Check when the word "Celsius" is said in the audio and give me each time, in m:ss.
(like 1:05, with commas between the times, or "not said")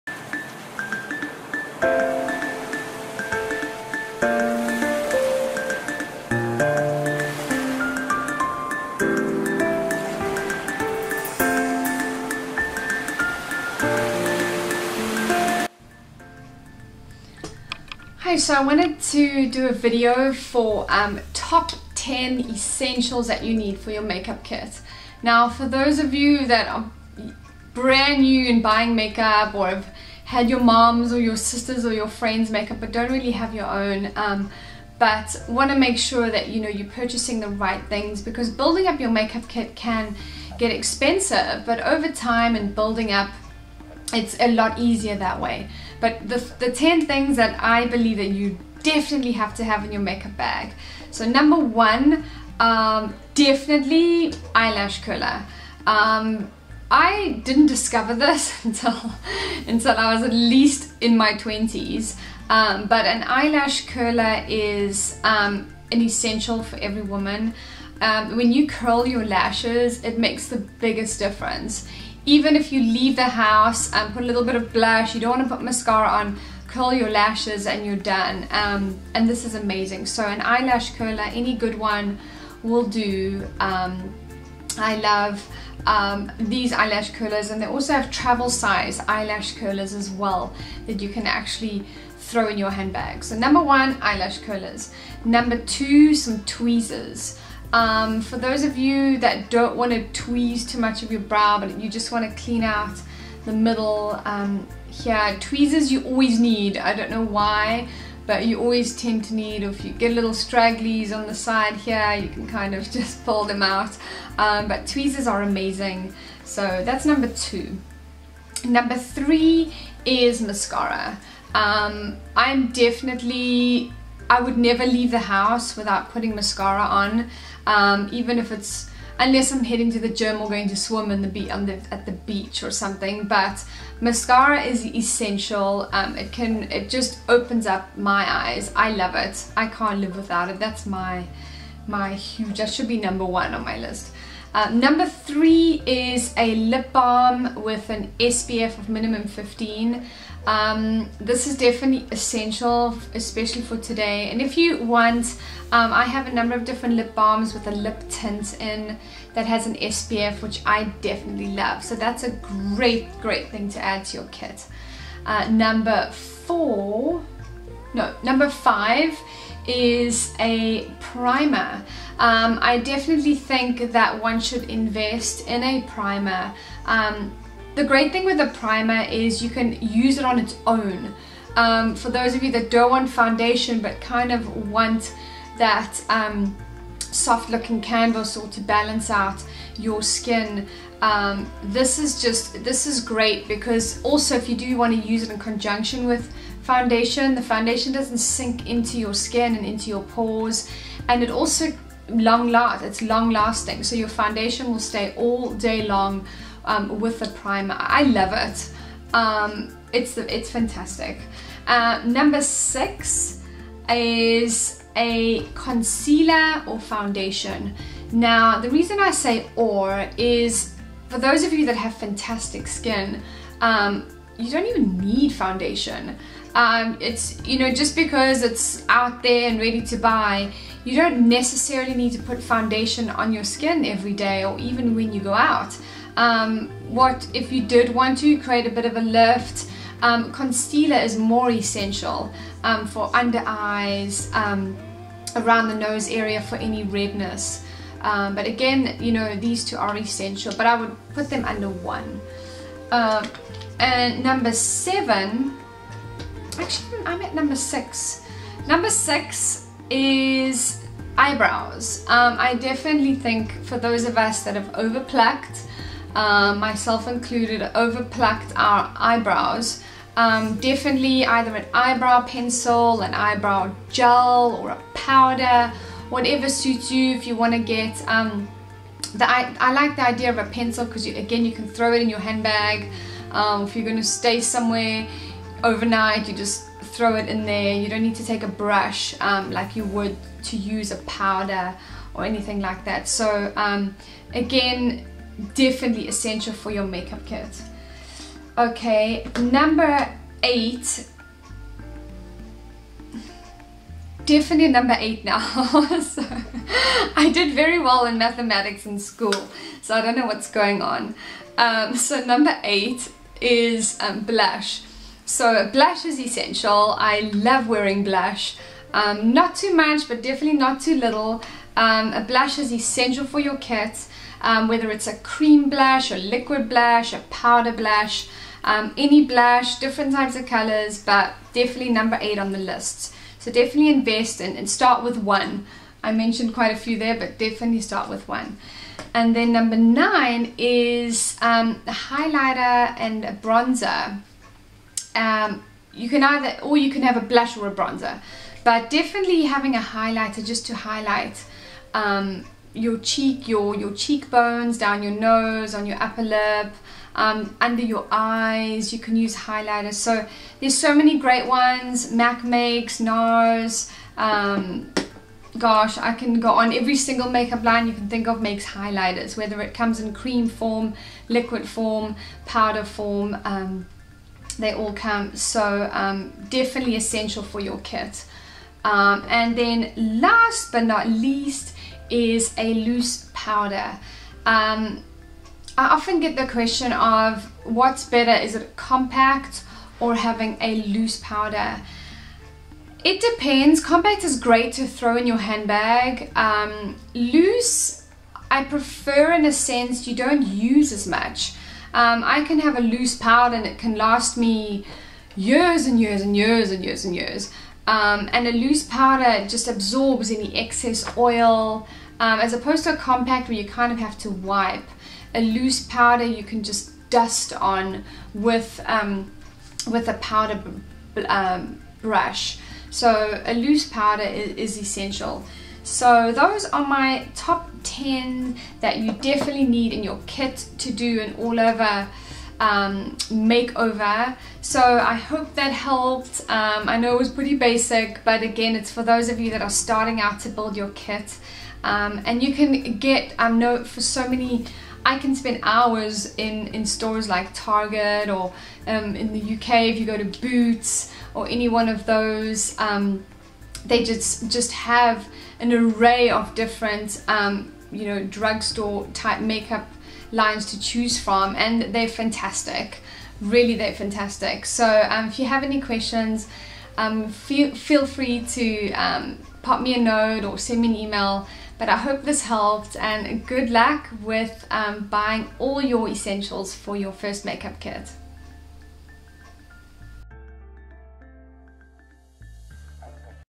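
not said.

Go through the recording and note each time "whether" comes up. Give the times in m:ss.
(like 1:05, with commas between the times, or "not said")
5:24, 6:09.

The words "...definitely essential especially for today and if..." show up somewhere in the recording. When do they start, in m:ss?
2:31.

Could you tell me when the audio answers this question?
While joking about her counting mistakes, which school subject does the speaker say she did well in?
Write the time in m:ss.
5:08.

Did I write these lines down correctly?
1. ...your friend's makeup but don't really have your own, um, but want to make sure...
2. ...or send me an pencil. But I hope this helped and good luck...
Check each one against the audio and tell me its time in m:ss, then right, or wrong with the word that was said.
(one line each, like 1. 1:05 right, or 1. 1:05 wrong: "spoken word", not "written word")
1. 0:31 right
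2. 7:50 wrong: "email", not "pencil".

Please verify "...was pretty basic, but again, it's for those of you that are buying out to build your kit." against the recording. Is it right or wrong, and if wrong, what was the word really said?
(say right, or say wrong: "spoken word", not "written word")
wrong: "starting", not "buying".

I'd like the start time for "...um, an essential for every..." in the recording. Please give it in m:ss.
1:05.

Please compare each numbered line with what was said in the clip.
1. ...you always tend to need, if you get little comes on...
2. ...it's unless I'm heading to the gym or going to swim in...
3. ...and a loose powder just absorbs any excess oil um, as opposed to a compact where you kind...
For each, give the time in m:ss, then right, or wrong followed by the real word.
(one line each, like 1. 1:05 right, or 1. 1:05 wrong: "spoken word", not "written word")
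1. 1:48 wrong: "stragglies", not "comes"
2. 2:08 right
3. 6:48 right.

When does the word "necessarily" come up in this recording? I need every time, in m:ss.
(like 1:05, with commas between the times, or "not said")
3:51.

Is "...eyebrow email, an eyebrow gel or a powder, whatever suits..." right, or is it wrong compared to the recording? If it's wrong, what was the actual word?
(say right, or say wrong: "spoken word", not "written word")
wrong: "pencil", not "email".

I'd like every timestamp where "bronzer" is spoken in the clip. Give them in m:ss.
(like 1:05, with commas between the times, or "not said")
5:43, 5:47.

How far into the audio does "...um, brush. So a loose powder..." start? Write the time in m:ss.
7:01.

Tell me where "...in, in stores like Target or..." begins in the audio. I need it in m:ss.
7:26.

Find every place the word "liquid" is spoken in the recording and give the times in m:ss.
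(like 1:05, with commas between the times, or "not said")
5:26, 6:11.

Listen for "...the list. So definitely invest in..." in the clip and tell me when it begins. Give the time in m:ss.
5:32.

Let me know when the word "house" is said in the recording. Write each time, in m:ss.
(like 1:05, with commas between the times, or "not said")
1:13, 2:05.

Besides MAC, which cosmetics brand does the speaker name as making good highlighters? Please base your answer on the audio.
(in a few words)
NARS.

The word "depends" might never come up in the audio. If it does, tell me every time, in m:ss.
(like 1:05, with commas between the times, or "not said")
6:33.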